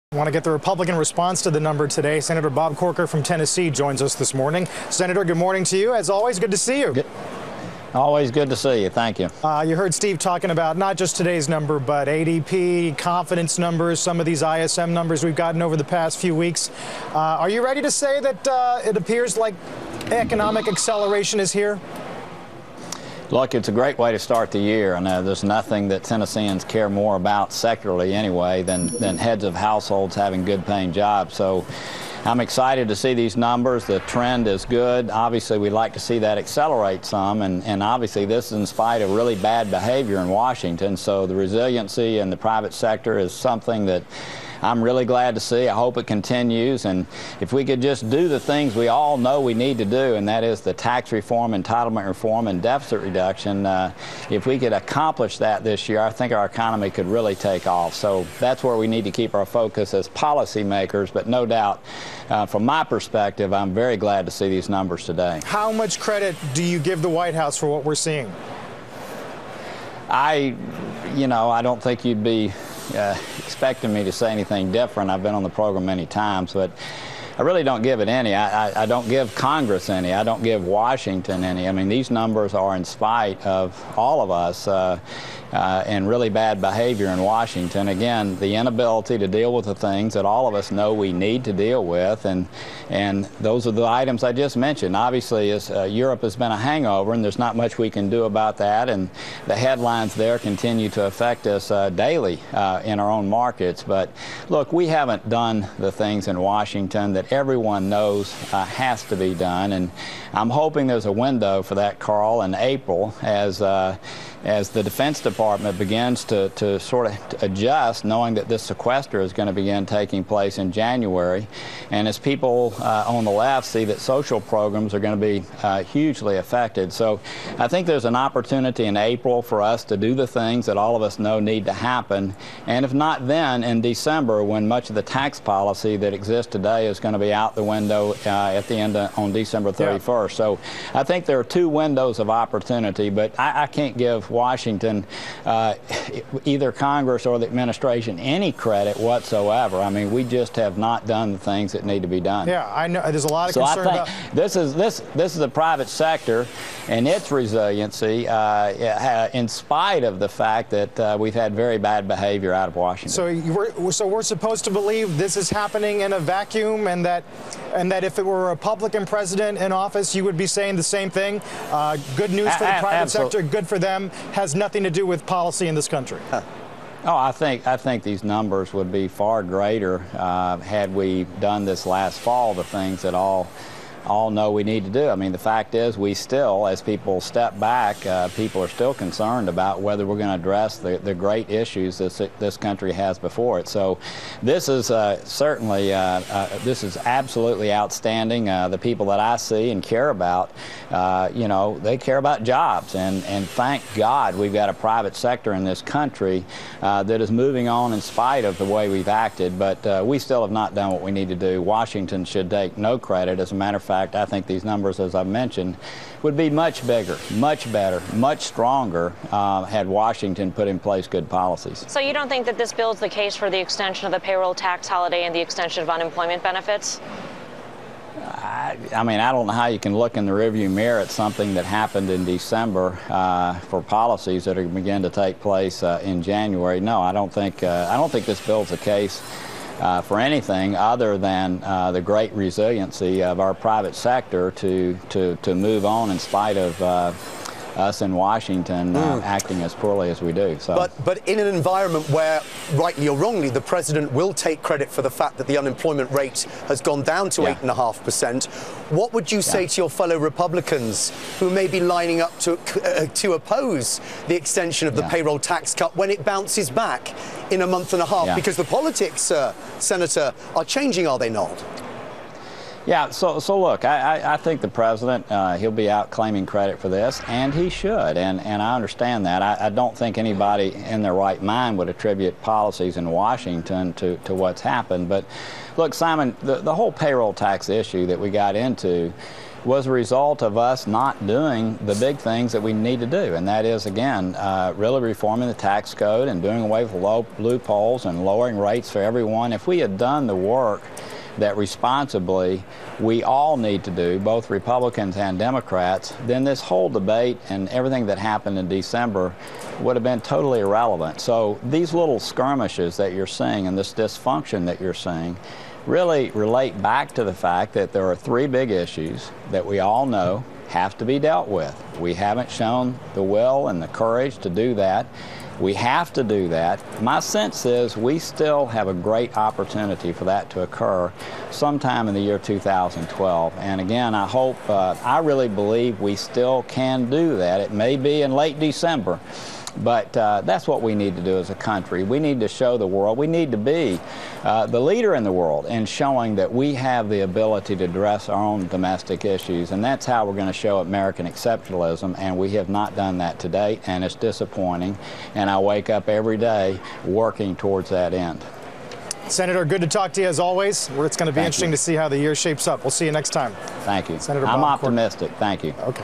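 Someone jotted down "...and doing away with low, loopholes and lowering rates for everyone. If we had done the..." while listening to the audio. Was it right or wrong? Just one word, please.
right.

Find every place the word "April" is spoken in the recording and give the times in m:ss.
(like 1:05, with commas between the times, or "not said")
1:52, 2:08.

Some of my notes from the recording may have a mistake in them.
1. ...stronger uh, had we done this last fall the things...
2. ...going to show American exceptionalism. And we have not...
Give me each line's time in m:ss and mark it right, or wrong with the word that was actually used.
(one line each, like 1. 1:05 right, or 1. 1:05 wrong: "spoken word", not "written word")
1. 2:59 wrong: "greater", not "stronger"
2. 5:50 right.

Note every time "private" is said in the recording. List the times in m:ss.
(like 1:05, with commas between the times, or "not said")
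0:42, 2:35, 2:52, 3:24, 4:03.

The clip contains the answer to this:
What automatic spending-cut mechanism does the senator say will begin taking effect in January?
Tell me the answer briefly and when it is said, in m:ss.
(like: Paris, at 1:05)
sequester, at 1:58.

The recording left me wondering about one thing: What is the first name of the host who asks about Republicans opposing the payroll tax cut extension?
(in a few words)
Simon.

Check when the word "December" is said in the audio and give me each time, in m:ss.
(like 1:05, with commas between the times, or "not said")
2:13, 2:19, 3:52, 5:08, 5:38.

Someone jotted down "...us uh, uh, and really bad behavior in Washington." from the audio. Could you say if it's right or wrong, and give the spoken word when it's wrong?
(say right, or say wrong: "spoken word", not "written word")
right.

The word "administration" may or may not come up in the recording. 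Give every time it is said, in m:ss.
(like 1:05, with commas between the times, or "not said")
2:27.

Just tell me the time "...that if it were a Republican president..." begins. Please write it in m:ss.
2:47.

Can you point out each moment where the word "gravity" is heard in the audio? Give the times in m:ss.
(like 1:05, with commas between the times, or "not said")
not said.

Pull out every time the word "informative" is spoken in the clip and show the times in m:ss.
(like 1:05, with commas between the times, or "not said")
not said.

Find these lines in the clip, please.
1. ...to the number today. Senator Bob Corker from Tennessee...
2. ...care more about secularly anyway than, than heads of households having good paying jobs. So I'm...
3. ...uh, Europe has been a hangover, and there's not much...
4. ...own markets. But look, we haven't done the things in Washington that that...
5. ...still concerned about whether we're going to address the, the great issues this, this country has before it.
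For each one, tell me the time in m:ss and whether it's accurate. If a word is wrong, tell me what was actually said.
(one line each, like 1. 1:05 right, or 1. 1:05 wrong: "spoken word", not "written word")
1. 0:01 right
2. 0:26 right
3. 1:35 right
4. 1:43 right
5. 3:08 right.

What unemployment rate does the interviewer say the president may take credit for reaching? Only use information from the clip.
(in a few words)
8.5%.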